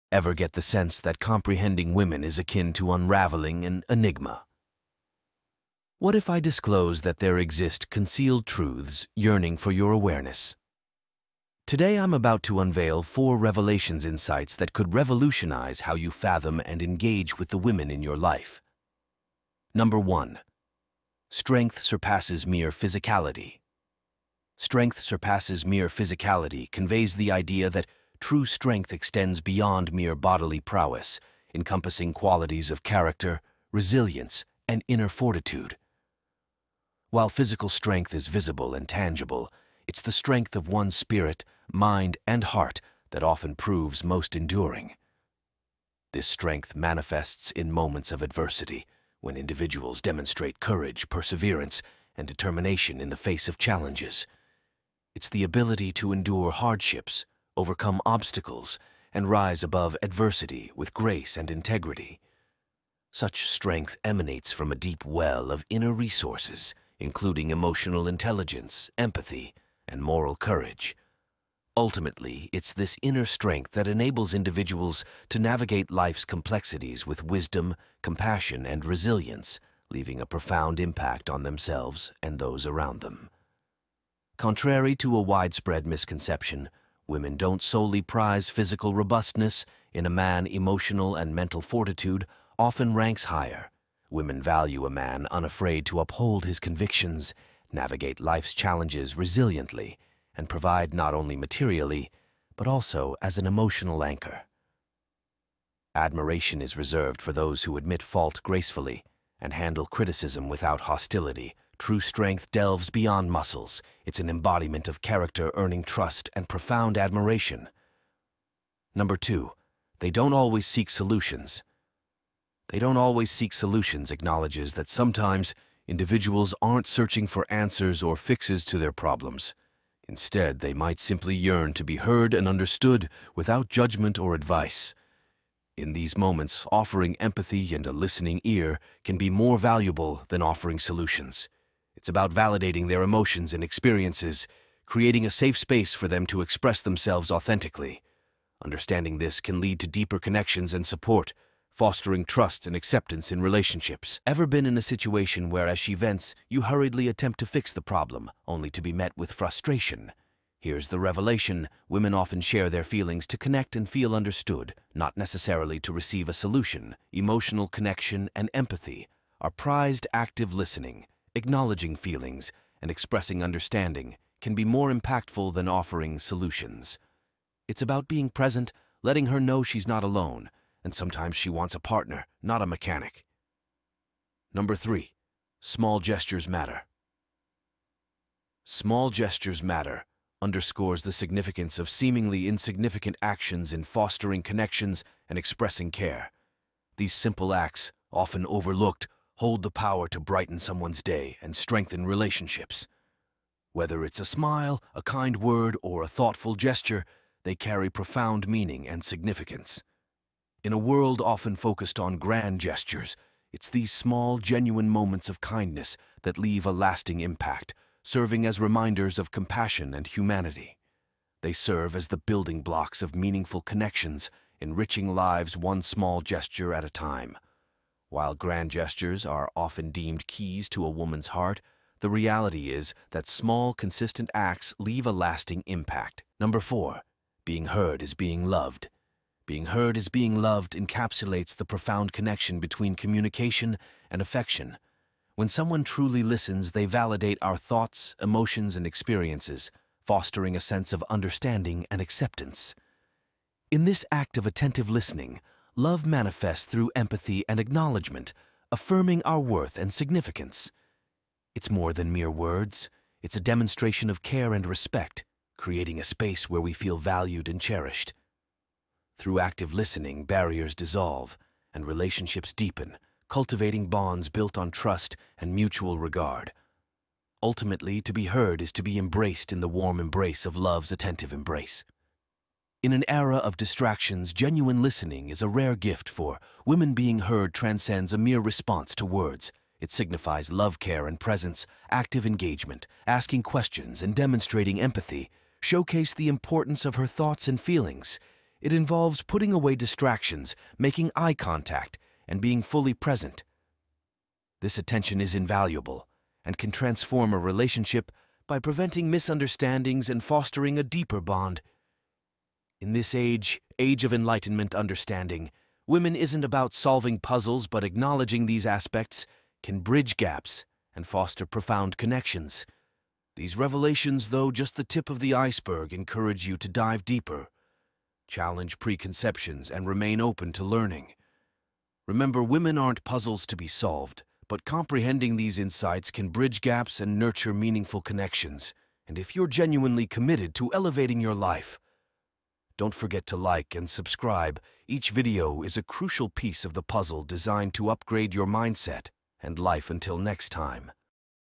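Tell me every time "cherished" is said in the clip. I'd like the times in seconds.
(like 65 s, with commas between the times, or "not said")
267 s.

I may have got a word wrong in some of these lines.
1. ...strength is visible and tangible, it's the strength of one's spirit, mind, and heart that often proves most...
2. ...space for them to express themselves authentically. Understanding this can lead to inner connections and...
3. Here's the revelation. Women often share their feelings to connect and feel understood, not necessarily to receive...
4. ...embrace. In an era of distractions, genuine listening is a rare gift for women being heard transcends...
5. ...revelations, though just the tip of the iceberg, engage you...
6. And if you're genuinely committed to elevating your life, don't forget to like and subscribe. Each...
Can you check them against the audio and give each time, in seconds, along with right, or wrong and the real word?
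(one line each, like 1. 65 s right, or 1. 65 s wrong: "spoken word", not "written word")
1. 37 s right
2. 145 s wrong: "deeper", not "inner"
3. 160 s right
4. 281 s right
5. 323 s wrong: "encourage", not "engage"
6. 339 s right.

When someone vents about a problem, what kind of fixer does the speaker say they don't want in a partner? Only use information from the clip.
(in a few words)
mechanic.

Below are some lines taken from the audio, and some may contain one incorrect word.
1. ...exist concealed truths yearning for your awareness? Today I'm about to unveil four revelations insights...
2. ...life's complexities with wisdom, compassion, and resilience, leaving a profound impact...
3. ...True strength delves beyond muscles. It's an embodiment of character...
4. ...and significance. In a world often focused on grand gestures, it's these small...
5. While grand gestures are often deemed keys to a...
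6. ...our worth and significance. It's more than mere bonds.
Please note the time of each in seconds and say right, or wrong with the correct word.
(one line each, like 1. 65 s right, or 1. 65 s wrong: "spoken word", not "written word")
1. 7 s right
2. 75 s right
3. 111 s right
4. 208 s right
5. 228 s right
6. 259 s wrong: "words", not "bonds".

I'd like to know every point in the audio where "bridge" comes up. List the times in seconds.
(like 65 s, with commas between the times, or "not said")
319 s, 336 s.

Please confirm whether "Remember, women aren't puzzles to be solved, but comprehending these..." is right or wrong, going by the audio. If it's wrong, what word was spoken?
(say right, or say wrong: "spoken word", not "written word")
right.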